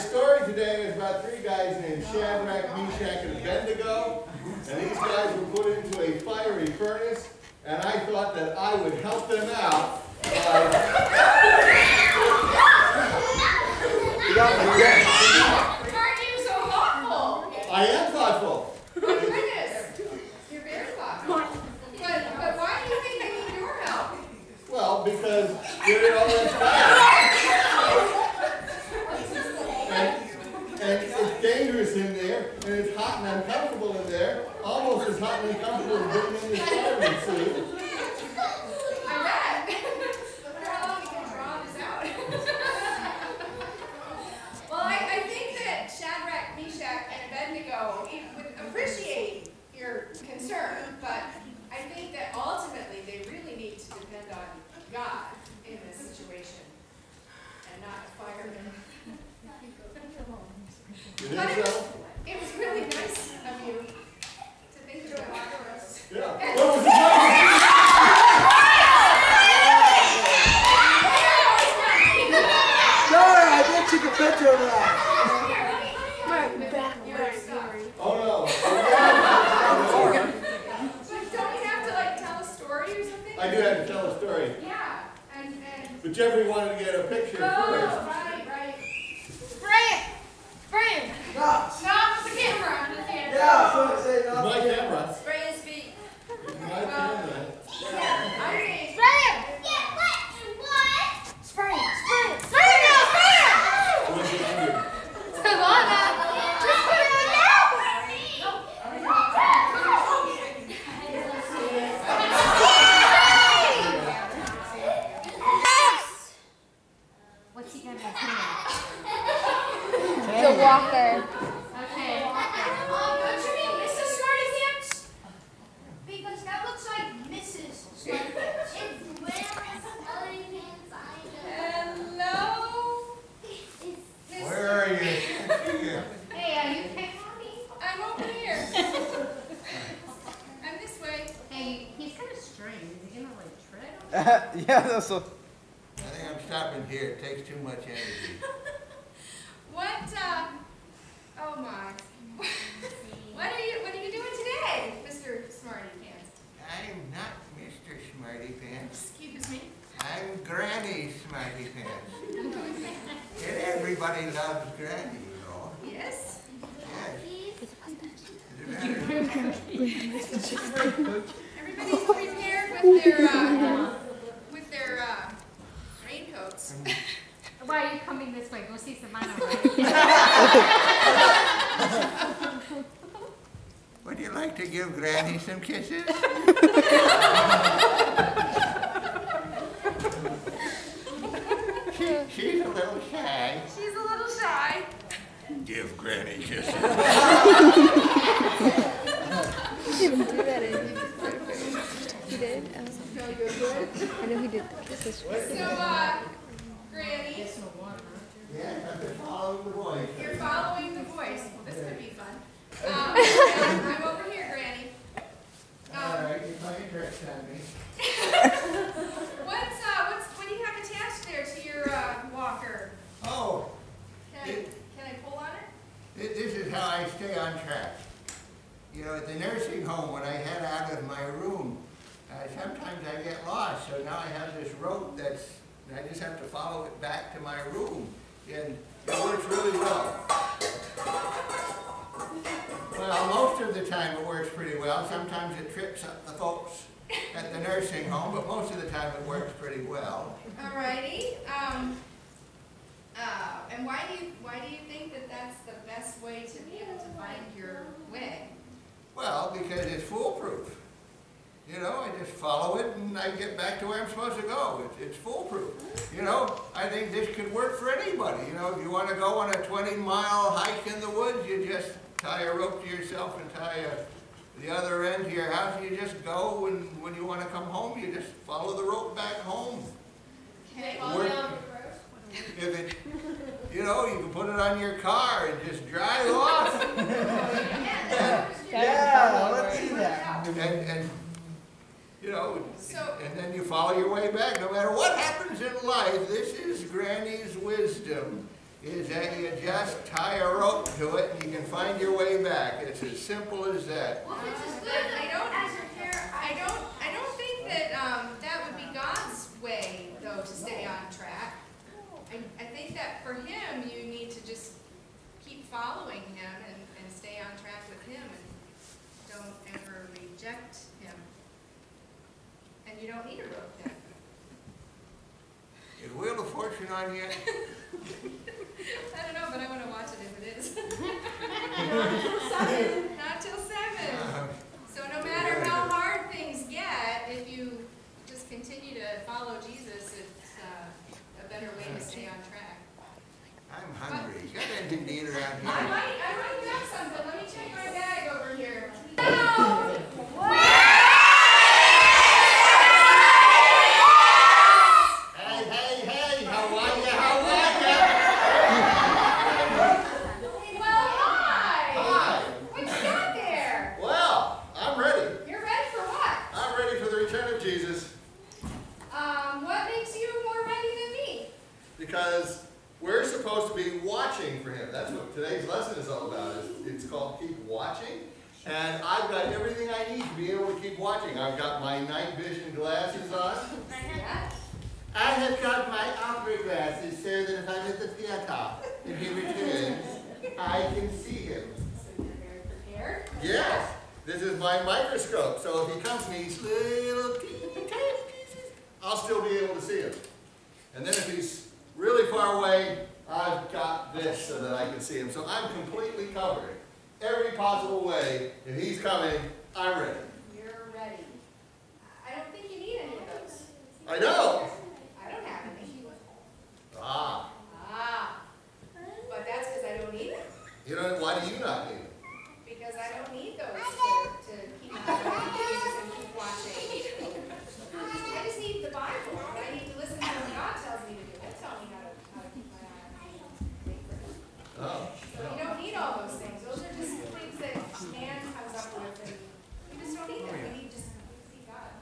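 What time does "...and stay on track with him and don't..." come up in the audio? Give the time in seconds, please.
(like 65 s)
317 s.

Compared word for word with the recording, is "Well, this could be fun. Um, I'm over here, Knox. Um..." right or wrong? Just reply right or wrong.
wrong.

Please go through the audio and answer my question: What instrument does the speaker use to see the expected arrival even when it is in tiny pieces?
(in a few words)
microscope.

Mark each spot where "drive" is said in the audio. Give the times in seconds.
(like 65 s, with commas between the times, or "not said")
285 s.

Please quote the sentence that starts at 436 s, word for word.
Those are just things that man comes up with, and you just don't need them.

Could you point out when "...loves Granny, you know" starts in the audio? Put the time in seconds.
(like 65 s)
164 s.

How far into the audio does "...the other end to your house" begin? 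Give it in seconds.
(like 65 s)
274 s.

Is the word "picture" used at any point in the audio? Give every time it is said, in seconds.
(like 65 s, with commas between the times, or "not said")
74 s, 87 s.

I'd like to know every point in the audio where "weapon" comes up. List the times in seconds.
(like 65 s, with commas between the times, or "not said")
not said.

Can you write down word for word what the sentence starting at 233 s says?
So now I have this rope that's, I just have to follow it back to my room.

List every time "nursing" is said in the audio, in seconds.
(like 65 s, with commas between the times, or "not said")
229 s, 247 s.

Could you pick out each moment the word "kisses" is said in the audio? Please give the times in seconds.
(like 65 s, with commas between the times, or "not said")
185 s, 196 s, 204 s.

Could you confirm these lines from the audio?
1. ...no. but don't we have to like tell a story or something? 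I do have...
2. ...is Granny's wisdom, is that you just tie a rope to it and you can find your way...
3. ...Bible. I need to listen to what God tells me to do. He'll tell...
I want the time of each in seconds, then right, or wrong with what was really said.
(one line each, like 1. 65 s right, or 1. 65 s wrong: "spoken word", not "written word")
1. 78 s right
2. 296 s right
3. 428 s right.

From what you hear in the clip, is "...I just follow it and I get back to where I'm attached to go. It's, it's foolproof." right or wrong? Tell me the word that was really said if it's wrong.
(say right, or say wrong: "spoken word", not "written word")
wrong: "supposed", not "attached".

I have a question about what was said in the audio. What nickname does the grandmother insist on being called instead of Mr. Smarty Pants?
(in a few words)
Granny Smarty Pants.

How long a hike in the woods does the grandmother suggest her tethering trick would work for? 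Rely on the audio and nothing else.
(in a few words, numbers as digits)
20 miles.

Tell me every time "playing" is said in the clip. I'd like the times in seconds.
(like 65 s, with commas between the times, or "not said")
216 s.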